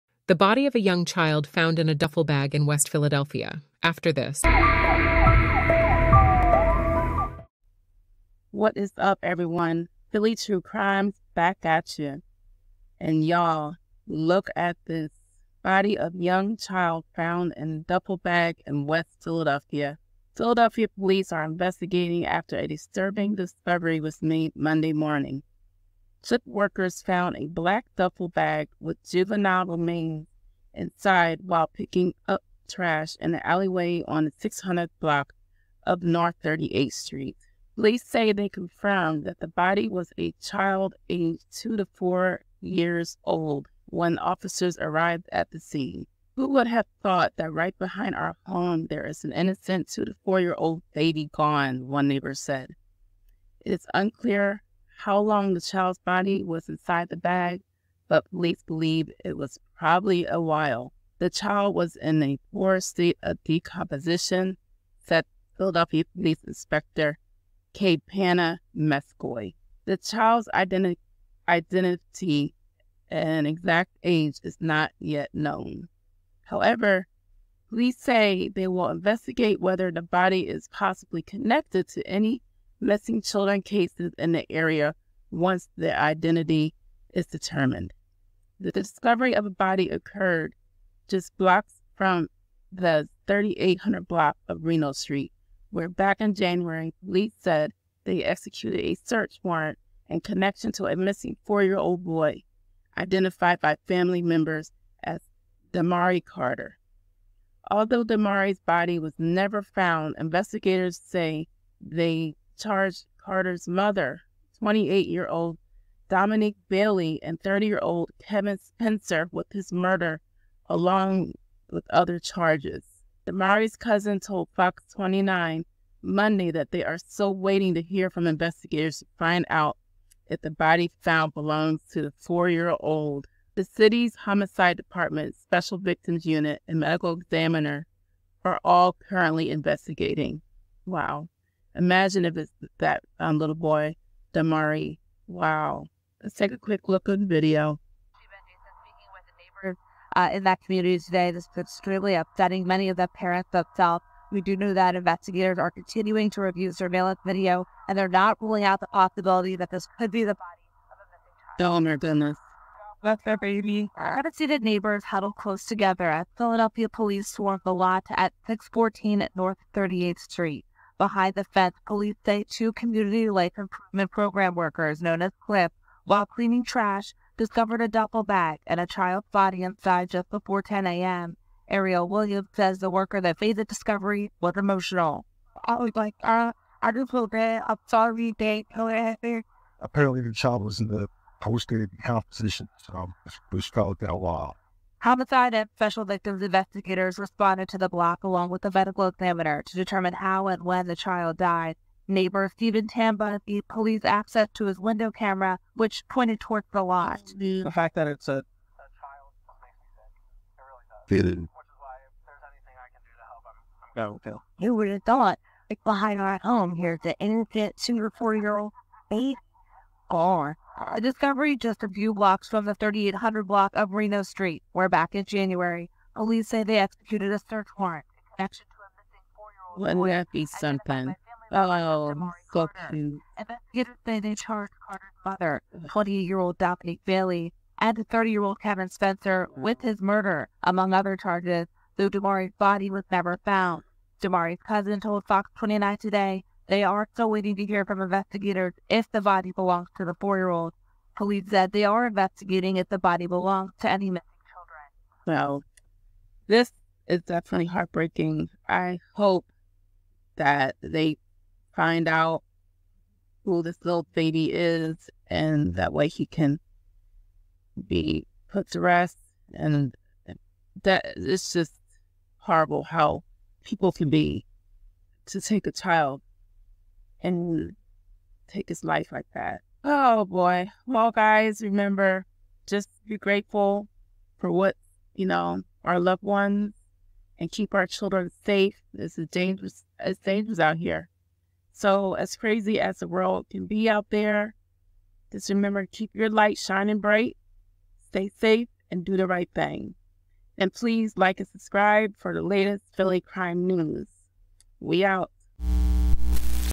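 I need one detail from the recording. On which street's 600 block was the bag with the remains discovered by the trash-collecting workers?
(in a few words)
North 38th Street.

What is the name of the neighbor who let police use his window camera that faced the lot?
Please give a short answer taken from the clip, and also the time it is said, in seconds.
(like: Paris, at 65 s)
Stephen Tamba, at 202 s.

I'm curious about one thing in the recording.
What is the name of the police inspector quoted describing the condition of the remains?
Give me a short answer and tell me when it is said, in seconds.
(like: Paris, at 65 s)
K. Panna Meskoy, at 67 s.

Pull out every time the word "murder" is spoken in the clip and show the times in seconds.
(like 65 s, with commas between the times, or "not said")
119 s, 240 s.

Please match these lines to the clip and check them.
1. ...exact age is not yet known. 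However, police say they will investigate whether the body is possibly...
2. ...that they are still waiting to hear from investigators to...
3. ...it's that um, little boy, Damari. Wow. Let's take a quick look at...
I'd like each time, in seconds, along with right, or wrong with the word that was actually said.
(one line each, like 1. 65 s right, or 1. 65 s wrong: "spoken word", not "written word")
1. 73 s right
2. 126 s right
3. 142 s right.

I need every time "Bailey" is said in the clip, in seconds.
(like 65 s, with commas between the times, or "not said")
116 s, 237 s.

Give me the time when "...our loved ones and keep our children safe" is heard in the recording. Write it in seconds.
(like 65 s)
285 s.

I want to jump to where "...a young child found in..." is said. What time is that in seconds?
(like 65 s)
0 s.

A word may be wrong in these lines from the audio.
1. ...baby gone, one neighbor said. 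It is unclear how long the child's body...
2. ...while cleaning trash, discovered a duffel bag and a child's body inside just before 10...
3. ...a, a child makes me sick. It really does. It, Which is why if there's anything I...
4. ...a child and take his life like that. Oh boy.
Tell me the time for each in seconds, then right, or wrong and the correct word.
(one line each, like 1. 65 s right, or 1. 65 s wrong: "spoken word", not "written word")
1. 50 s right
2. 176 s right
3. 208 s right
4. 275 s right.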